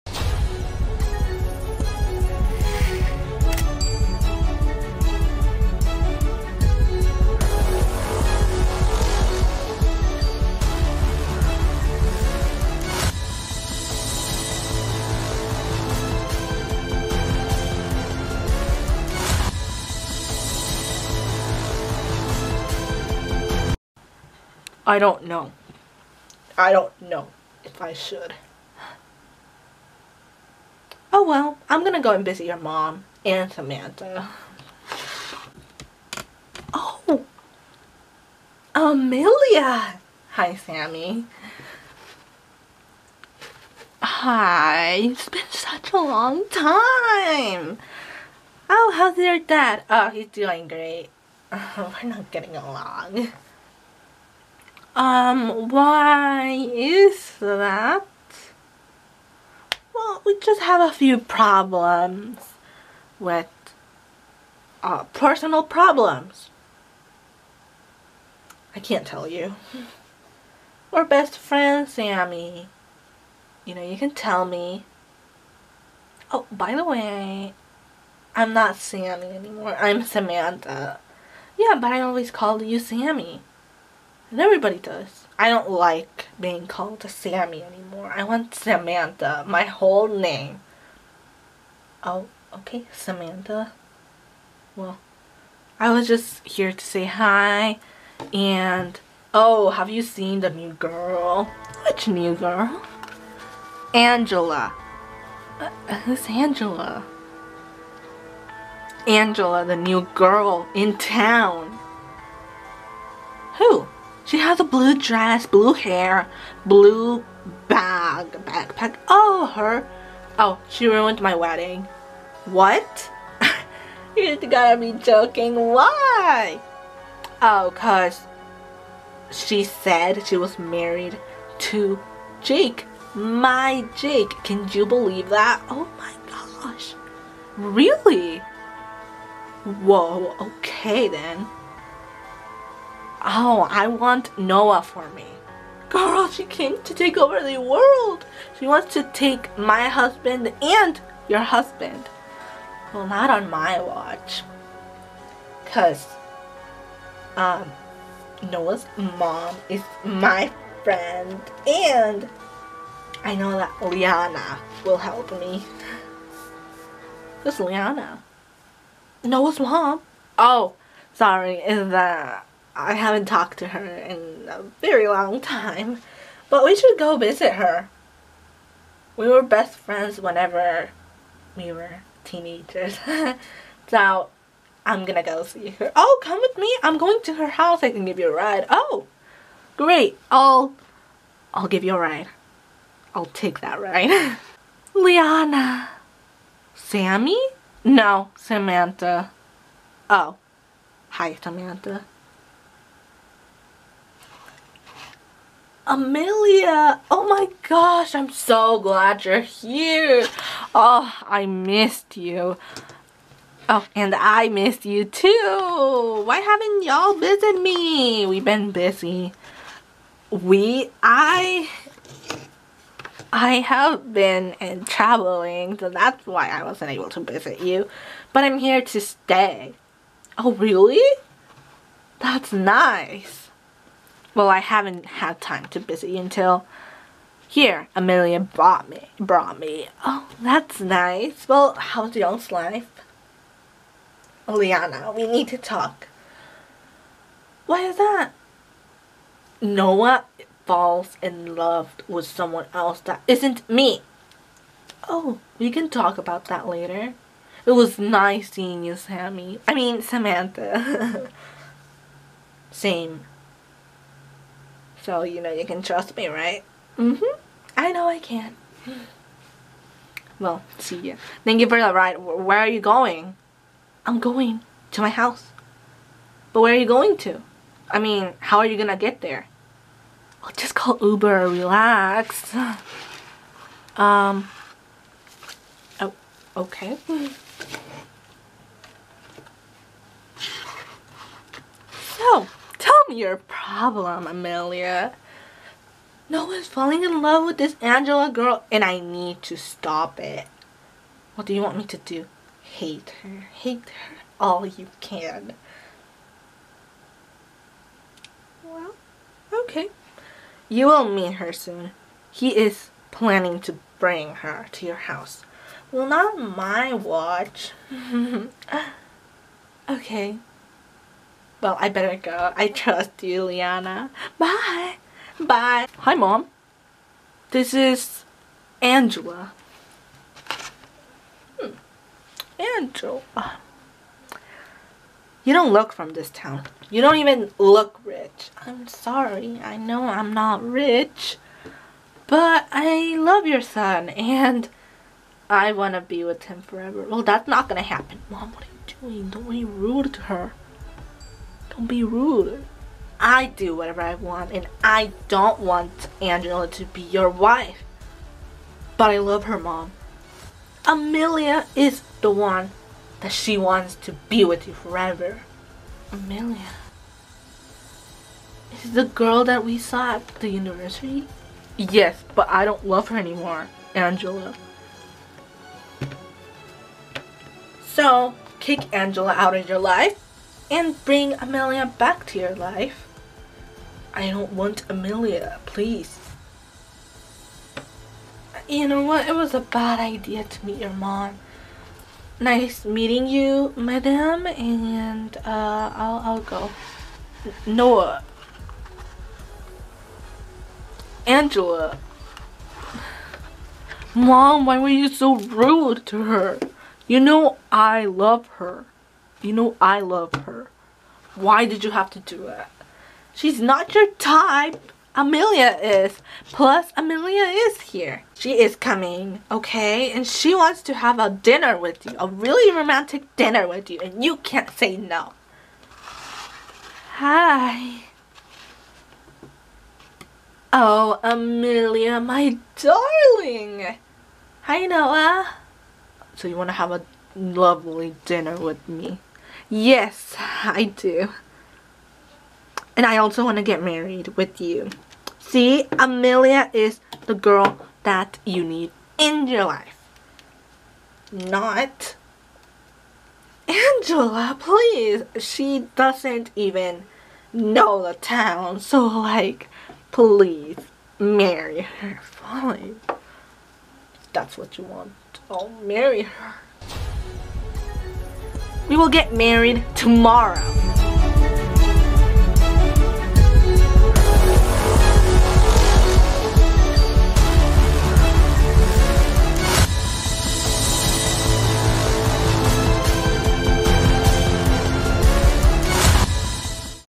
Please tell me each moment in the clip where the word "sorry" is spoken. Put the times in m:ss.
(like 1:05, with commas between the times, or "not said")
2:51, 5:38.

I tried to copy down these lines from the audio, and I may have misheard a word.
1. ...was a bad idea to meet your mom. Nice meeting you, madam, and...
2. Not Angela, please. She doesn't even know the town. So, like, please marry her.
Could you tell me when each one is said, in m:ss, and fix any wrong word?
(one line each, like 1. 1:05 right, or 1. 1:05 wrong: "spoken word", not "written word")
1. 6:29 right
2. 7:31 right.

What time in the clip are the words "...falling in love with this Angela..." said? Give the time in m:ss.
4:56.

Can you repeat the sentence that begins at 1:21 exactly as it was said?
Yeah, but I always called you Sammy.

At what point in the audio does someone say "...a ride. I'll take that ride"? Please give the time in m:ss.
3:11.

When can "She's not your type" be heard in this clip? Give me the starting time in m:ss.
6:53.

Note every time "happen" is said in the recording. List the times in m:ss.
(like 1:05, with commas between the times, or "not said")
5:47.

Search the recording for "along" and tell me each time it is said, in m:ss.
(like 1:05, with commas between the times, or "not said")
0:52.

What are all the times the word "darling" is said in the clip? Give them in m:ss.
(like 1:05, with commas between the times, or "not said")
7:12.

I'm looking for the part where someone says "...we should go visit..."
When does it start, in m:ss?
2:56.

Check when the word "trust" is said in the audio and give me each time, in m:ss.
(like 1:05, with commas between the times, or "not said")
4:25, 5:22.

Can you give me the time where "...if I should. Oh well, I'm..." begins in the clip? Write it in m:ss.
0:27.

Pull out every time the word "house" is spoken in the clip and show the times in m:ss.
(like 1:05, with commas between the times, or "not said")
3:07, 4:35, 5:14.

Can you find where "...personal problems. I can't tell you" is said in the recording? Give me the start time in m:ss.
1:05.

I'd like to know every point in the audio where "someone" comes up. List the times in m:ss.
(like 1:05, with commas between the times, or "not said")
4:12.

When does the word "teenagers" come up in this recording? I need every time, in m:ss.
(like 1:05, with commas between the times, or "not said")
3:02.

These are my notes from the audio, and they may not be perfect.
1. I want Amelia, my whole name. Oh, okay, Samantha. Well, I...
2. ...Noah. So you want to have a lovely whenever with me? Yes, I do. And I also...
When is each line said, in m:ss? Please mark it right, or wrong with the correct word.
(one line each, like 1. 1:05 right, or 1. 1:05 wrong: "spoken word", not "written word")
1. 1:28 wrong: "Samantha", not "Amelia"
2. 7:14 wrong: "dinner", not "whenever".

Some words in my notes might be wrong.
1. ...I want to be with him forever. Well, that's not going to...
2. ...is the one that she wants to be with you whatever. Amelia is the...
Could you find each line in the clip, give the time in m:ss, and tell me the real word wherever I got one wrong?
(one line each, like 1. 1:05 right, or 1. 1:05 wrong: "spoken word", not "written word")
1. 5:45 right
2. 6:01 wrong: "forever", not "whatever".